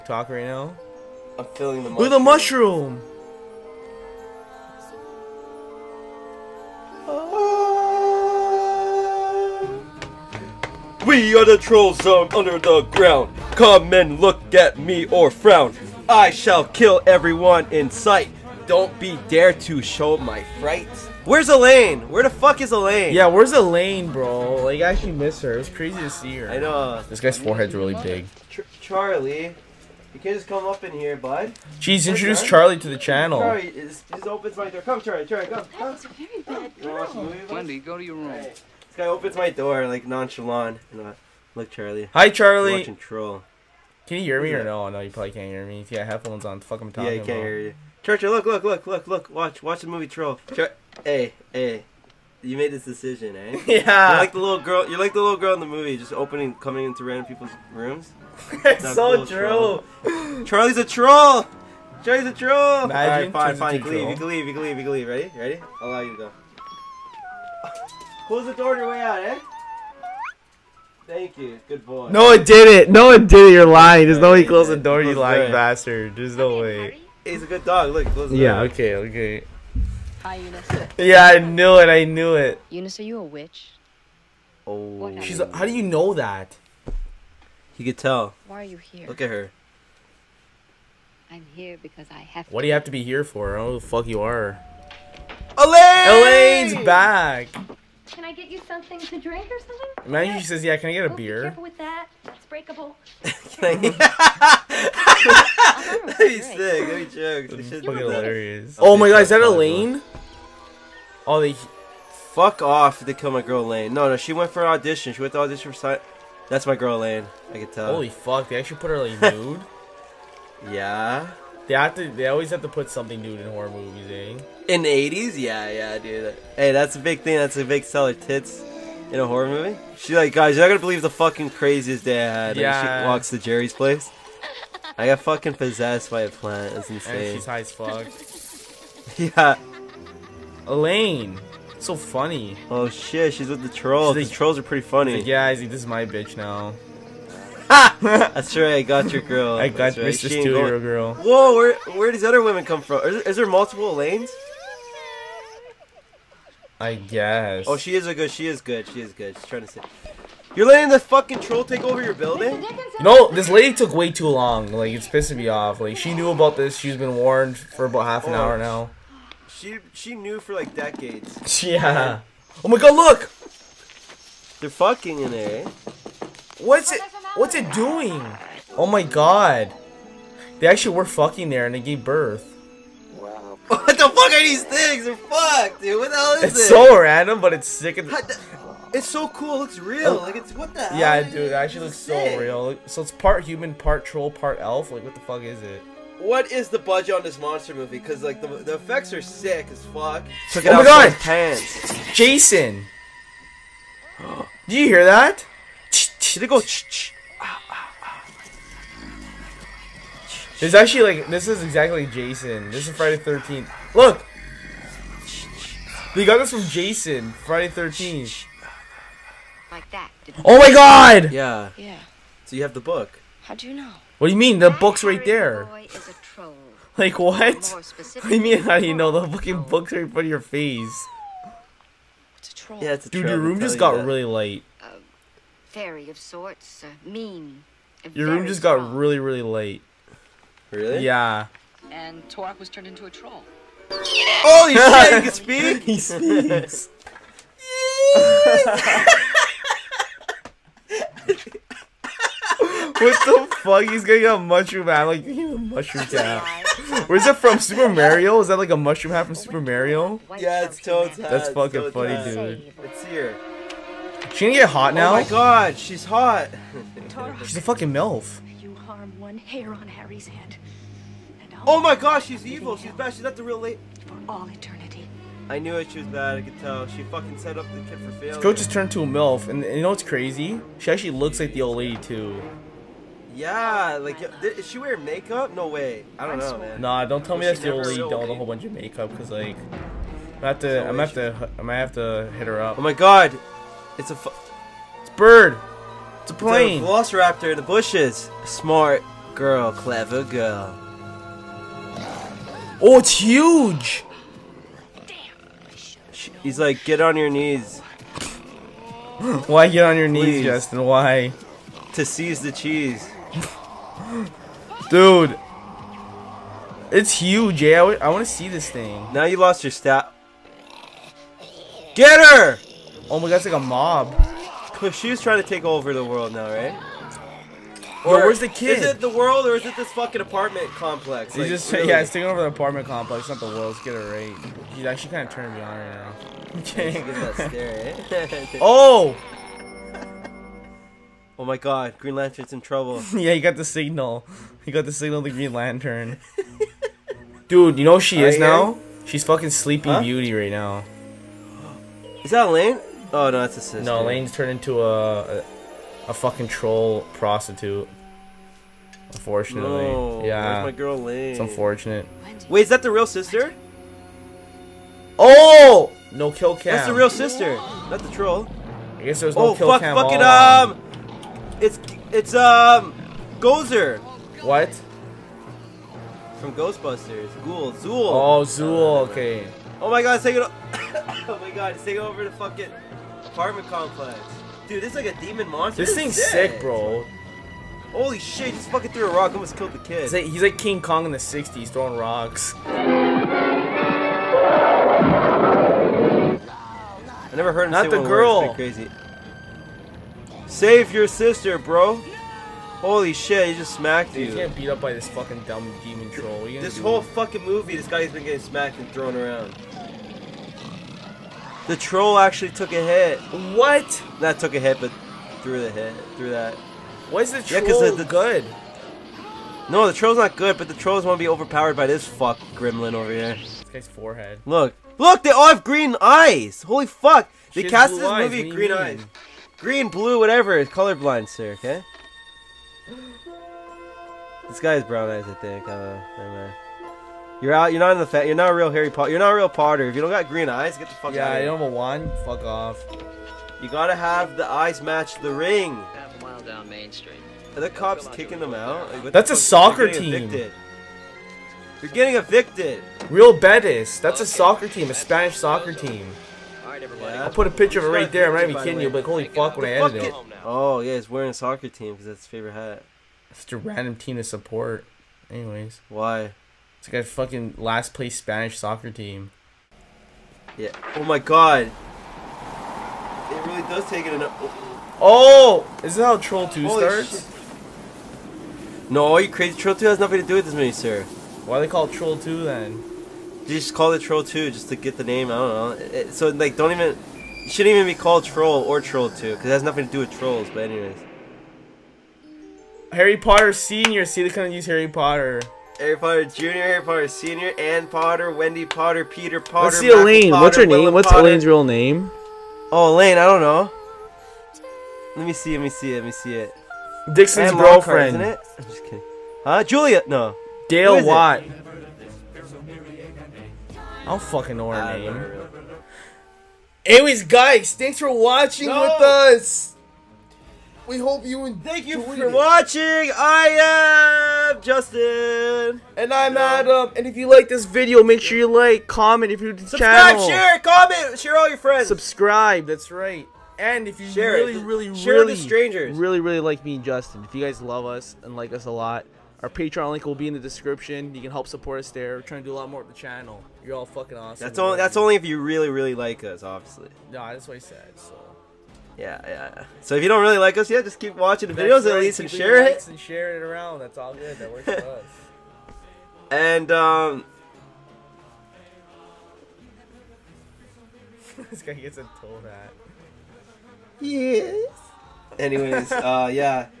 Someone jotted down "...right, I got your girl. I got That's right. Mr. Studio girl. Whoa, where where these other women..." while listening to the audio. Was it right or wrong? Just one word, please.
right.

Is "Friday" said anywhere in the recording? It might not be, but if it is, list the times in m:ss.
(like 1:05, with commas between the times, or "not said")
3:32, 3:37.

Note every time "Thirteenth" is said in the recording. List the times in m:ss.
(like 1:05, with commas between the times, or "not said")
3:33, 3:37.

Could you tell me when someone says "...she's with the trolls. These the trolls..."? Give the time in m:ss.
2:23.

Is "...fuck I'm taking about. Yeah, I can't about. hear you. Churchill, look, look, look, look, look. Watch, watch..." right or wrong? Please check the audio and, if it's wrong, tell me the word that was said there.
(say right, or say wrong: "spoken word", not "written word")
wrong: "talking", not "taking".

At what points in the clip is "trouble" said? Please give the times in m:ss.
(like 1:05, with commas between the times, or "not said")
5:42.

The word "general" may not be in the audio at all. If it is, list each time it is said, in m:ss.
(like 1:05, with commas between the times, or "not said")
not said.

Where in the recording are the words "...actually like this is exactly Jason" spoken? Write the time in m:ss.
3:30.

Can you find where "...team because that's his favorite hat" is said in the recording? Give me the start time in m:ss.
7:41.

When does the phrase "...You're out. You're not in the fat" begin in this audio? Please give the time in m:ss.
7:17.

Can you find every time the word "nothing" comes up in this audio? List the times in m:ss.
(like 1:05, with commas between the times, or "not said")
7:59, 8:09.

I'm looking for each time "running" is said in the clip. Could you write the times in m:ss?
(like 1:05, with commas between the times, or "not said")
not said.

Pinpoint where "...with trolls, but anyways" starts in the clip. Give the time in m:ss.
8:09.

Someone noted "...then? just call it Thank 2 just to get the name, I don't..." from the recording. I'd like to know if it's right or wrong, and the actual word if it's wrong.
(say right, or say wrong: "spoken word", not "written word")
wrong: "Troll", not "Thank".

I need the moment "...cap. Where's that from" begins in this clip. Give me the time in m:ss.
4:16.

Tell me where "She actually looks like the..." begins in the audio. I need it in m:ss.
4:40.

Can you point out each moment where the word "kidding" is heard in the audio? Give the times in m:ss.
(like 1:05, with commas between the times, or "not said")
7:38, 8:28.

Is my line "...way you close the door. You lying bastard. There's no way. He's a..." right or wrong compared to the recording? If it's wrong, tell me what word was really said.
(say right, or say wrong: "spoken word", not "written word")
right.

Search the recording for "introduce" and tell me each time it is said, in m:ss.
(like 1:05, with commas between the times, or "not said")
0:32.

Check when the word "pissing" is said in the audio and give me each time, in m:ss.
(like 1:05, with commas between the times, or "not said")
2:45.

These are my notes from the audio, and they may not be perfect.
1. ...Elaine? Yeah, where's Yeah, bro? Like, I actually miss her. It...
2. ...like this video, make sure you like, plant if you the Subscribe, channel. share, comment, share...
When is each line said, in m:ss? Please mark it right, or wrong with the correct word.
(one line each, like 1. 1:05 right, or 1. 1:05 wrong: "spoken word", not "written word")
1. 0:22 wrong: "Elaine", not "Yeah"
2. 8:47 wrong: "comment", not "plant".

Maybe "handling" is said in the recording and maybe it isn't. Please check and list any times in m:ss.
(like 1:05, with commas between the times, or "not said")
not said.